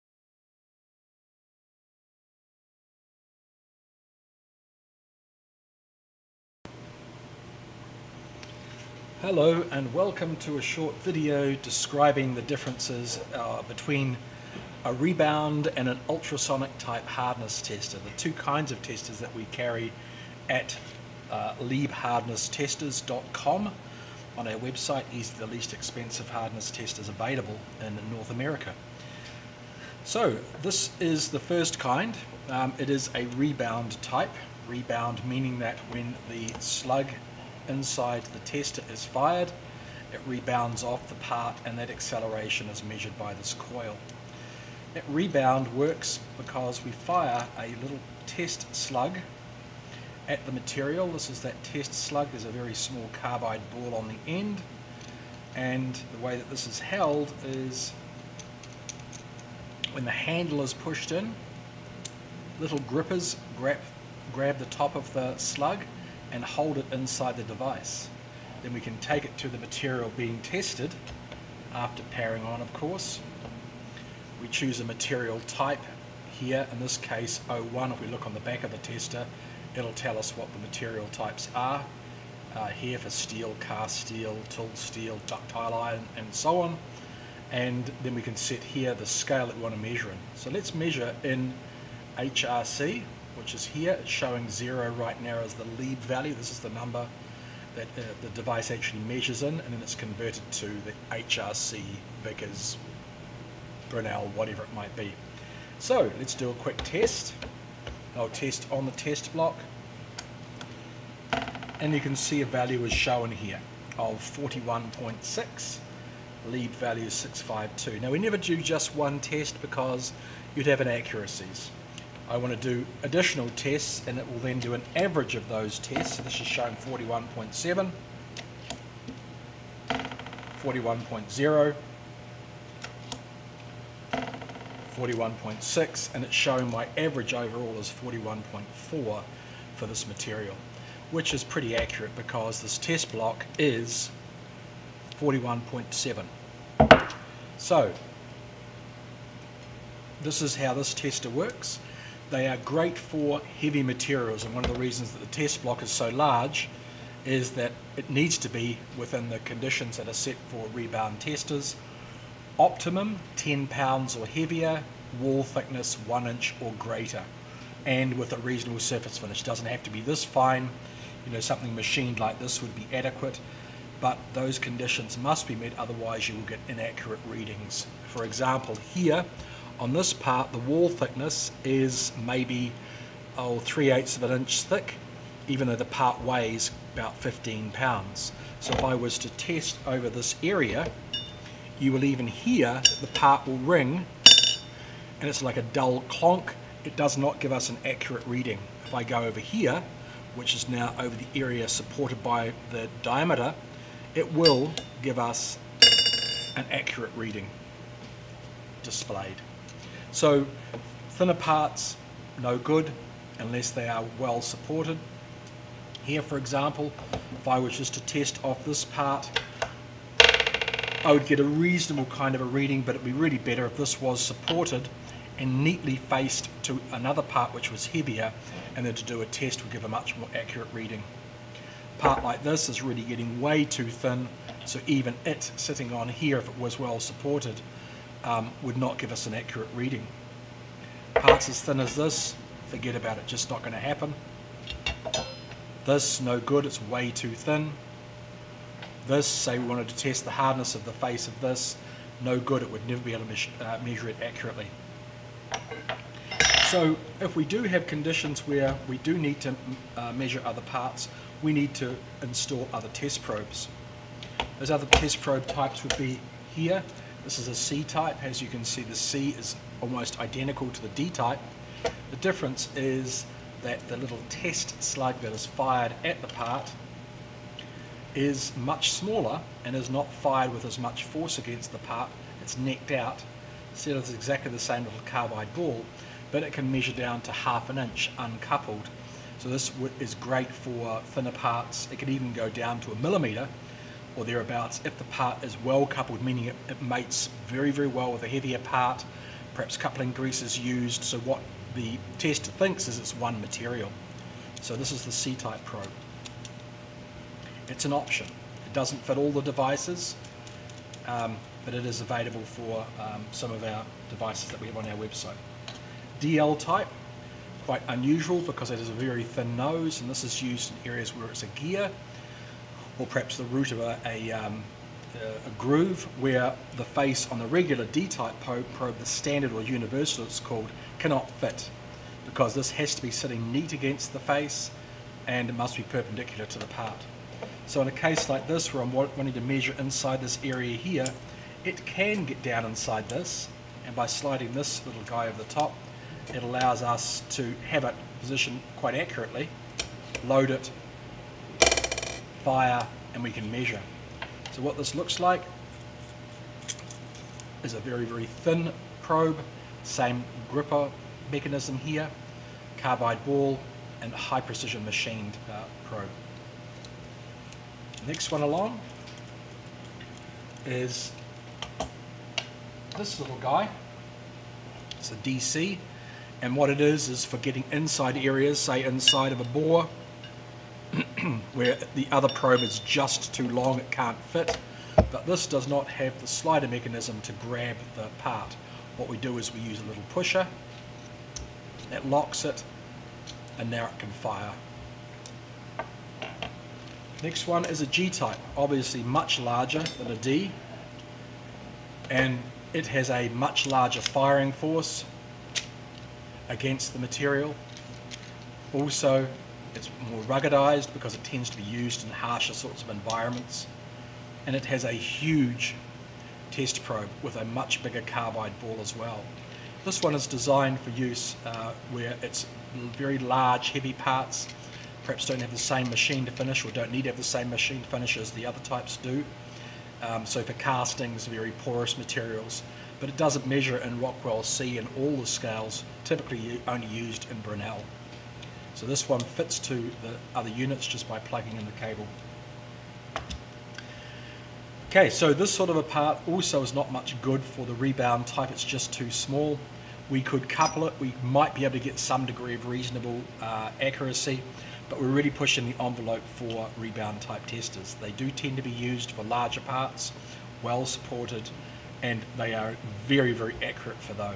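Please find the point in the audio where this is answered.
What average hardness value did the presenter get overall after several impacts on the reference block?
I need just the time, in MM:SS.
02:17.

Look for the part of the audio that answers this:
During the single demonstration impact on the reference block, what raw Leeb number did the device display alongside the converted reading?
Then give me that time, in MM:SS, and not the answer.
01:57.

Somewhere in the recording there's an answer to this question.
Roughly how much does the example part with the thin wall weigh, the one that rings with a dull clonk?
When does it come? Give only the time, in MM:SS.
03:07.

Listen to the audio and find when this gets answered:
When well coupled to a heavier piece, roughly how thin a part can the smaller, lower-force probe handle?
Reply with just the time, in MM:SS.
04:52.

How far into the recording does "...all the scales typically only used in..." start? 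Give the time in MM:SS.
07:14.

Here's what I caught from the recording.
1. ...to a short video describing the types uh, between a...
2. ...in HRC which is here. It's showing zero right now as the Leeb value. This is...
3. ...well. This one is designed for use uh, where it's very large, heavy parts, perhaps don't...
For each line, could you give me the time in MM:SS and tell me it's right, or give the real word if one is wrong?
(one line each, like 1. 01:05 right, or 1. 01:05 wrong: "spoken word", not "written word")
1. 00:10 wrong: "differences", not "types"
2. 01:31 right
3. 06:58 right.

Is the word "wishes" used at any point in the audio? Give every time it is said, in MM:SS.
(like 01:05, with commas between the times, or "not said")
not said.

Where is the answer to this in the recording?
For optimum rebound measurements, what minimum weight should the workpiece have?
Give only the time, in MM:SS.
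02:43.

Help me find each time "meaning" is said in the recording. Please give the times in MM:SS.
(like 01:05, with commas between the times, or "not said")
00:35, 04:56.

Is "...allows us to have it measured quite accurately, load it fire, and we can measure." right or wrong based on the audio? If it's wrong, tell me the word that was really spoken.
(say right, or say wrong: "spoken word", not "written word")
wrong: "positioned", not "measured".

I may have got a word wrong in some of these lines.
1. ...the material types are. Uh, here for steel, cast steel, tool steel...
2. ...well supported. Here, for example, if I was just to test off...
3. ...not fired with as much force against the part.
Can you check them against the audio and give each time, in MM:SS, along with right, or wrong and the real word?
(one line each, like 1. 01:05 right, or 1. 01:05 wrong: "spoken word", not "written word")
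1. 01:20 right
2. 03:34 right
3. 04:39 right.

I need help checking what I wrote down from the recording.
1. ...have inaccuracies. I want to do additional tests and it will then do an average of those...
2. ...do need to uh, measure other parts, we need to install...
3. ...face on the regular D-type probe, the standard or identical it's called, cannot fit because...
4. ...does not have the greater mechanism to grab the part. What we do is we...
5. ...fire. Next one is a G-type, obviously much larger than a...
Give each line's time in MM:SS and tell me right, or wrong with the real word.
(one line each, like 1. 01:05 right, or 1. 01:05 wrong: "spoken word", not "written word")
1. 02:00 right
2. 04:18 right
3. 05:26 wrong: "universal", not "identical"
4. 06:25 wrong: "slider", not "greater"
5. 06:34 right.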